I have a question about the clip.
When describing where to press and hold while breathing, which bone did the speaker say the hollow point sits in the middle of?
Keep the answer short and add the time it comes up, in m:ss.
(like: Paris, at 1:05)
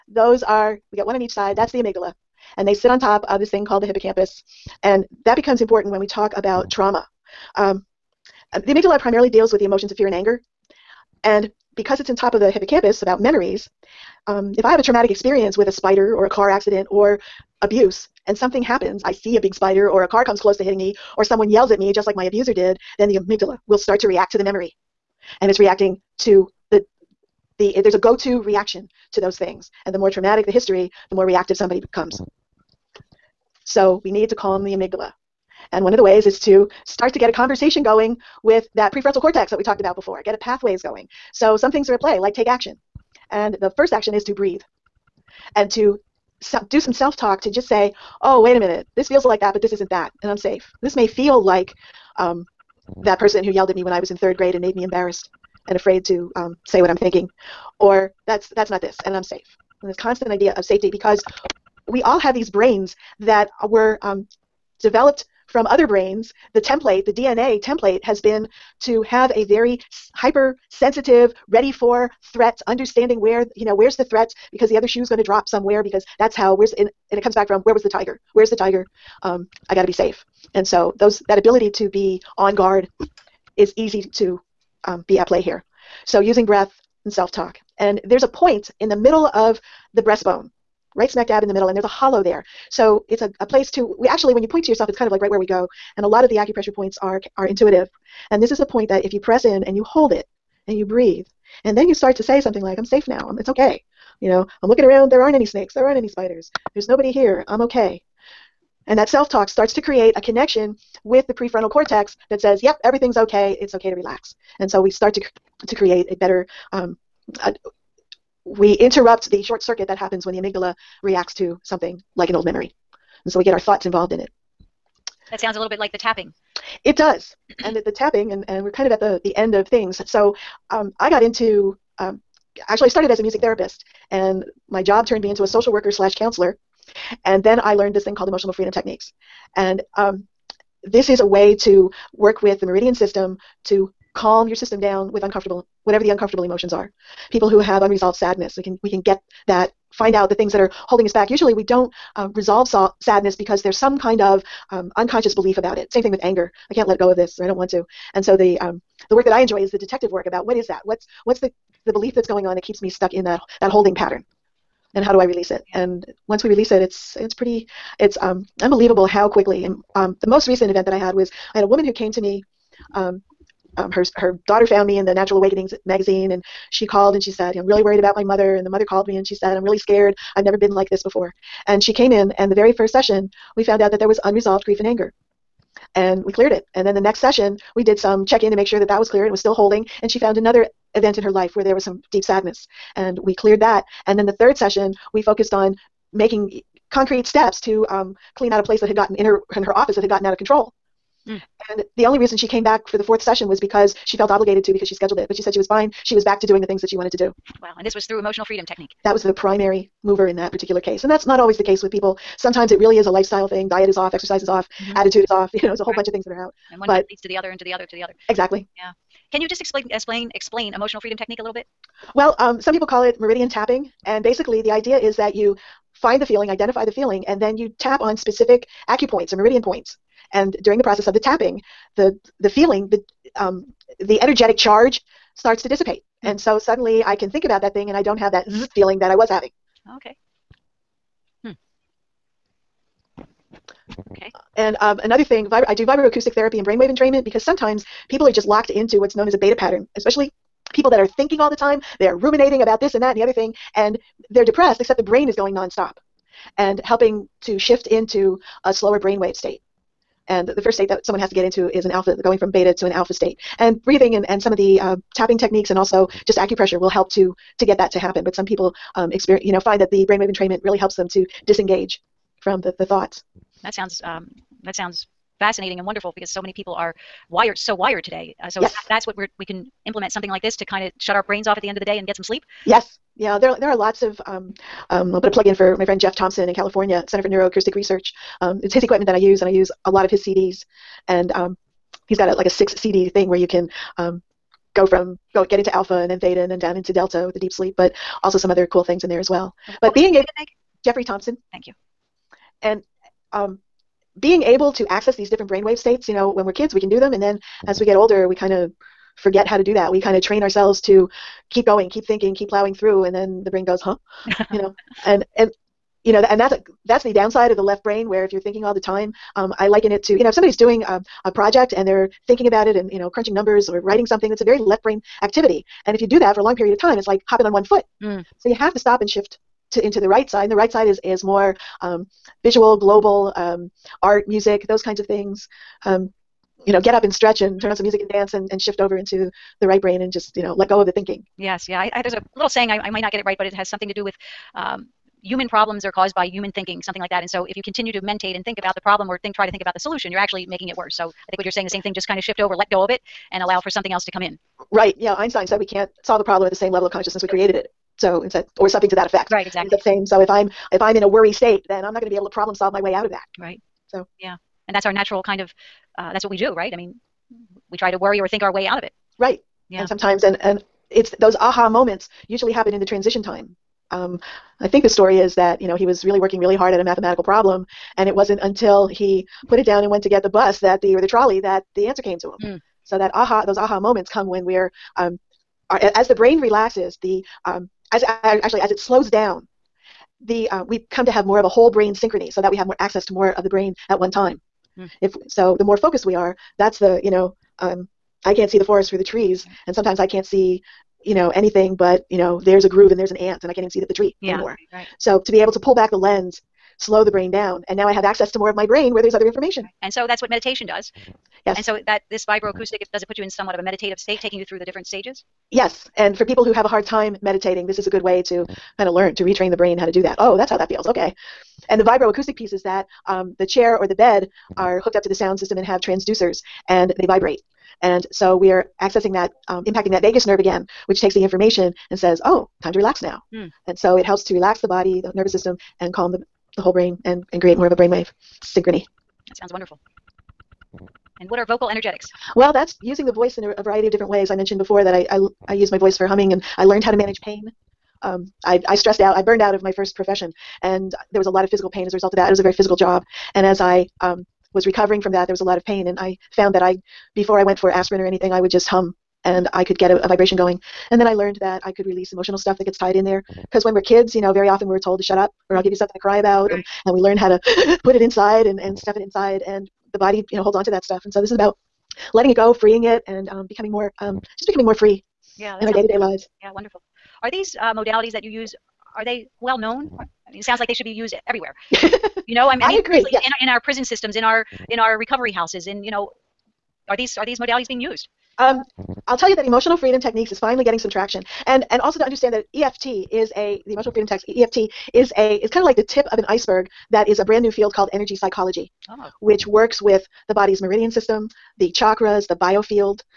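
breastbone, at 1:30.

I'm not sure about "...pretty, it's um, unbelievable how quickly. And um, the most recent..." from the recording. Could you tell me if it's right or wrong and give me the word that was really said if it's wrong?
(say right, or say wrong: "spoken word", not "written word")
right.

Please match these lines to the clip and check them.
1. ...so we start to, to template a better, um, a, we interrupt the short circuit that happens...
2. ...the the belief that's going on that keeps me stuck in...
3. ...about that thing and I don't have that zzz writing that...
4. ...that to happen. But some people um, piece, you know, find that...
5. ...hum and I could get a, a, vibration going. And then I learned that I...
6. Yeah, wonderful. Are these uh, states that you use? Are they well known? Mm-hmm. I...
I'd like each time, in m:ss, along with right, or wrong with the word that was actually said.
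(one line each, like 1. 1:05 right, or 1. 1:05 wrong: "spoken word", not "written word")
1. 1:54 wrong: "create", not "template"
2. 2:41 right
3. 3:57 wrong: "feeling", not "writing"
4. 4:27 wrong: "experience", not "piece"
5. 7:38 right
6. 7:56 wrong: "modalities", not "states".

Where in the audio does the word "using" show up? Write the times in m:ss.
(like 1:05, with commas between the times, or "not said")
1:26, 7:22.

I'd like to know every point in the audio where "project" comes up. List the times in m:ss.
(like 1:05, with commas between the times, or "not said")
5:21.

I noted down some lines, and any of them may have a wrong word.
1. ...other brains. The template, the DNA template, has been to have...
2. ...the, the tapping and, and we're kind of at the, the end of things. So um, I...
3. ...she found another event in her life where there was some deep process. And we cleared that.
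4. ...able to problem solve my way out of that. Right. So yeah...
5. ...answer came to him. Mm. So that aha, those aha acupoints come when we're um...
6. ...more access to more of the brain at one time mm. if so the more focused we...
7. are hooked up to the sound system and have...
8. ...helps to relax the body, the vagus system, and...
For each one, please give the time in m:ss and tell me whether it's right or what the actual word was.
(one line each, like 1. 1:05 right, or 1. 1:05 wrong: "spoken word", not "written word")
1. 1:05 right
2. 2:07 right
3. 3:10 wrong: "sadness", not "process"
4. 6:02 right
5. 6:21 wrong: "moments", not "acupoints"
6. 6:32 right
7. 7:04 right
8. 7:14 wrong: "nervous", not "vagus".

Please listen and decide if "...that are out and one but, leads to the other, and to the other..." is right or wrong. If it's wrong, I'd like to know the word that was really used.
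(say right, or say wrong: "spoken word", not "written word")
right.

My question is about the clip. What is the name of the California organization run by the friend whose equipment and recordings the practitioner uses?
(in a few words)
Center for Neuroacoustic Research.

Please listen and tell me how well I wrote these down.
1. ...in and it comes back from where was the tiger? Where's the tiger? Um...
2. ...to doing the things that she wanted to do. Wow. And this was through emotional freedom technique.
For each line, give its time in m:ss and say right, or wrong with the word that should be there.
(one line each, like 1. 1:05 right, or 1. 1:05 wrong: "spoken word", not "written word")
1. 1:16 right
2. 3:26 right.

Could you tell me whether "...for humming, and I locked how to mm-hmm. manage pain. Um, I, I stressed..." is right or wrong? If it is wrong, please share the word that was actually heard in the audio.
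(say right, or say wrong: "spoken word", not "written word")
wrong: "learned", not "locked".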